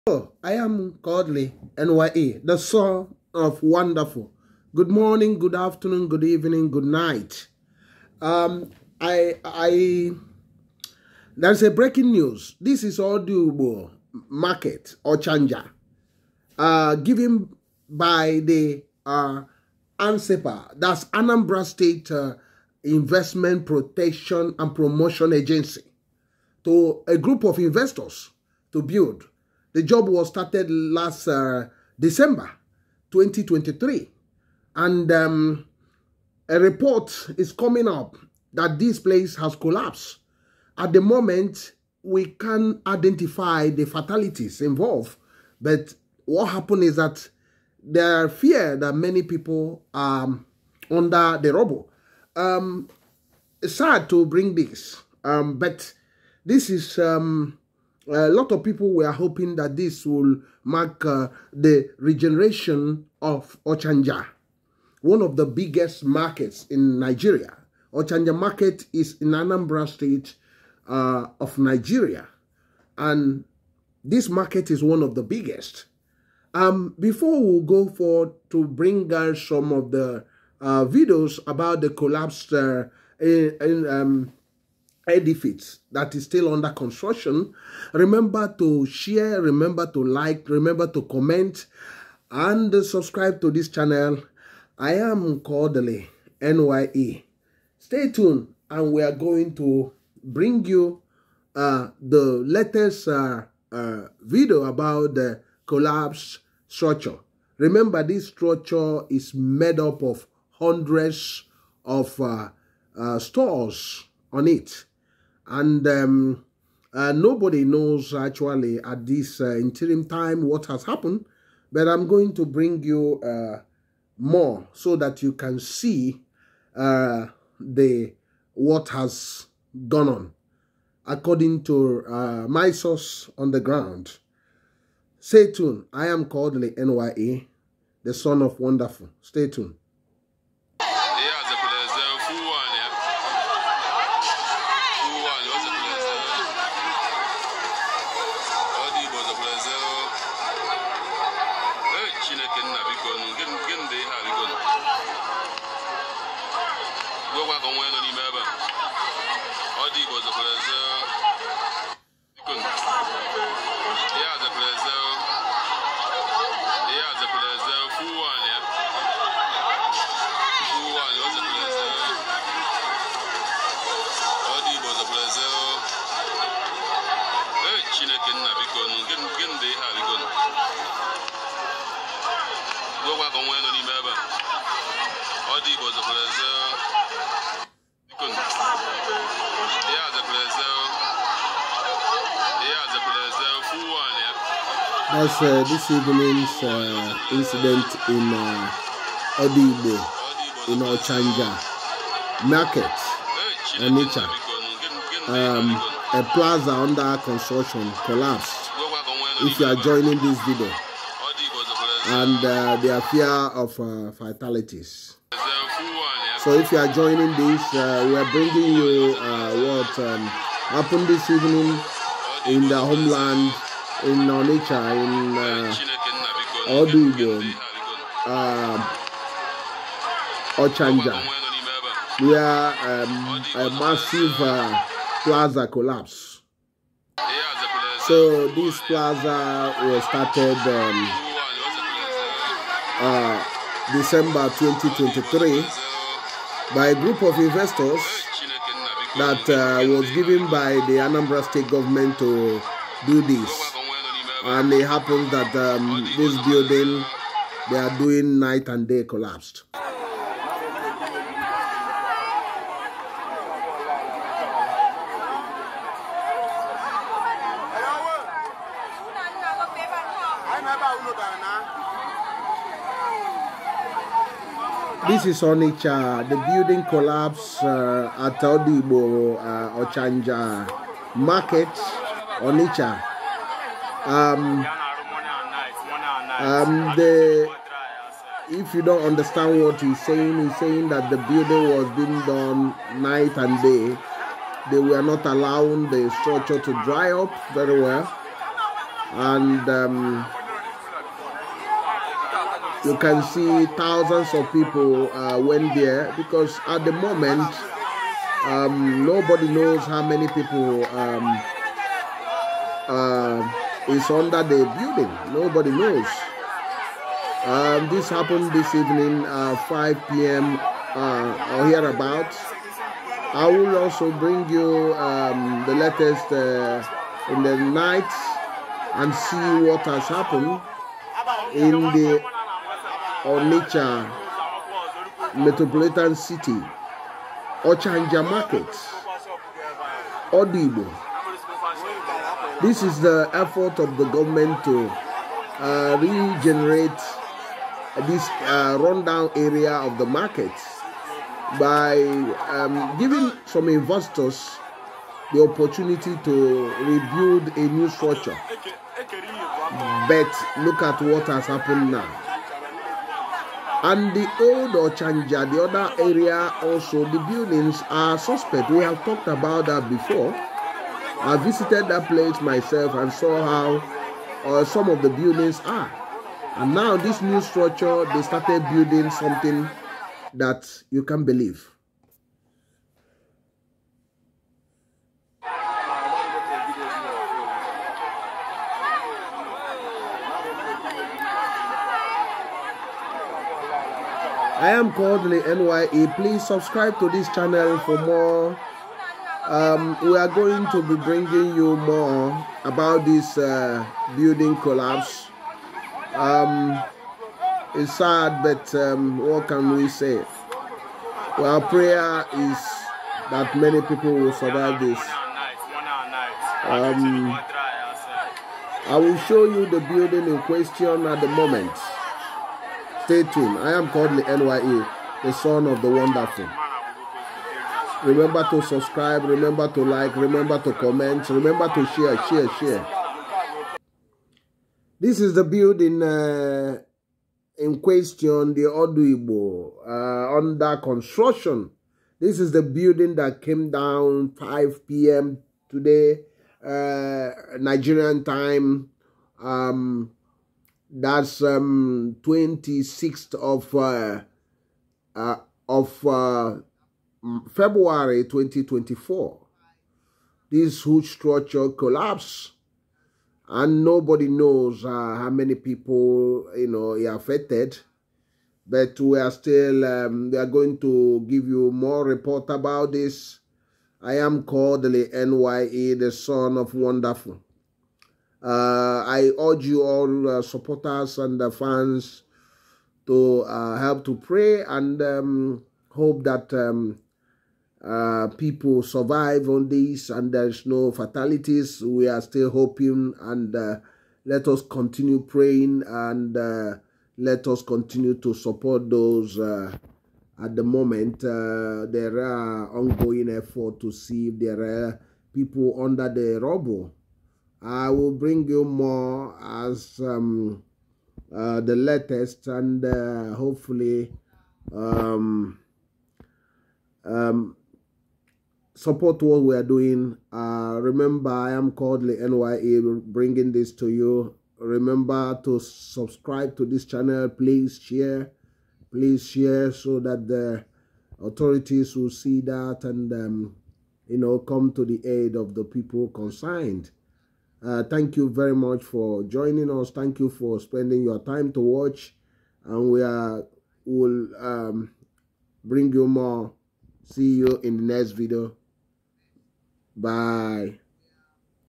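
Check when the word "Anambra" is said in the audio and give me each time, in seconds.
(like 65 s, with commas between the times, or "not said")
21 s, 69 s, 250 s.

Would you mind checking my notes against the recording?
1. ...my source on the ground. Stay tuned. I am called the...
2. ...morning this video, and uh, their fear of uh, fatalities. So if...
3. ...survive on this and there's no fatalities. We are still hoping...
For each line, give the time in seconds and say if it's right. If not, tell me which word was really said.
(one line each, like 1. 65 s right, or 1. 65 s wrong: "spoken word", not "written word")
1. 132 s right
2. 209 s wrong: "joining", not "morning"
3. 488 s right.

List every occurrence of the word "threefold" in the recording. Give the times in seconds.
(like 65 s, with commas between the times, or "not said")
not said.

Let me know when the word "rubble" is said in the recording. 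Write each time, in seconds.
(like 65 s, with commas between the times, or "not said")
51 s, 506 s.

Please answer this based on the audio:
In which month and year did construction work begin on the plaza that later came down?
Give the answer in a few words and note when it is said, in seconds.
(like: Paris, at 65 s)
December 2023, at 30 s.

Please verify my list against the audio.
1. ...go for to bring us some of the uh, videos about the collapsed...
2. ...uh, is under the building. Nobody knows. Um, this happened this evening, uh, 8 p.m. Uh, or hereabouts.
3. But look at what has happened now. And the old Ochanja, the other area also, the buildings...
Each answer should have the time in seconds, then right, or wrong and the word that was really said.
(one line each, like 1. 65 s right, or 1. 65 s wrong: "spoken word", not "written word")
1. 77 s right
2. 312 s wrong: "5", not "8"
3. 360 s right.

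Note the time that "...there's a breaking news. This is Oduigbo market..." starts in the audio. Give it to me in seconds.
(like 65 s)
11 s.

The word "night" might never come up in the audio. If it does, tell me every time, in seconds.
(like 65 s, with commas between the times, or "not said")
6 s, 258 s, 293 s, 327 s.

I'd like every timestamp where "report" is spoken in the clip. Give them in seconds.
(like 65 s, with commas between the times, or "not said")
36 s, 472 s.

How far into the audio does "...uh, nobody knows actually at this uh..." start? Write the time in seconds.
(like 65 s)
116 s.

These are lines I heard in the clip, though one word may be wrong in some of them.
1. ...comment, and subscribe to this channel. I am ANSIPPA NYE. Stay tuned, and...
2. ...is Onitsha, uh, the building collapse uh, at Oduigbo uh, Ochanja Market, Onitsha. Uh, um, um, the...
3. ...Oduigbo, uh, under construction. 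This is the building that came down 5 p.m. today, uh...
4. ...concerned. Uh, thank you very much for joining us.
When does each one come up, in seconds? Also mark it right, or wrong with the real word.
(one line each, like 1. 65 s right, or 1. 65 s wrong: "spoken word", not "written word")
1. 91 s wrong: "Cordley", not "ANSIPPA"
2. 275 s right
3. 438 s right
4. 536 s right.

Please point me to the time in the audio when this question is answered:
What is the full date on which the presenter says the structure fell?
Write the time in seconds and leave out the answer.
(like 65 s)
452 s.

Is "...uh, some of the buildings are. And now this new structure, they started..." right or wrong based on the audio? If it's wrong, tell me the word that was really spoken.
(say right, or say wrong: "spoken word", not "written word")
right.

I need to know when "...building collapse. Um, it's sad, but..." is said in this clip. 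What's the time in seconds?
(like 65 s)
404 s.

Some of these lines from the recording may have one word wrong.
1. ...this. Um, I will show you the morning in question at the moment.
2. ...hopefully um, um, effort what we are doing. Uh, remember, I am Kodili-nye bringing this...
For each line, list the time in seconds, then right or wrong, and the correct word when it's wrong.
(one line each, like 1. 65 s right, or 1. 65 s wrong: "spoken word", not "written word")
1. 414 s wrong: "building", not "morning"
2. 513 s wrong: "support", not "effort".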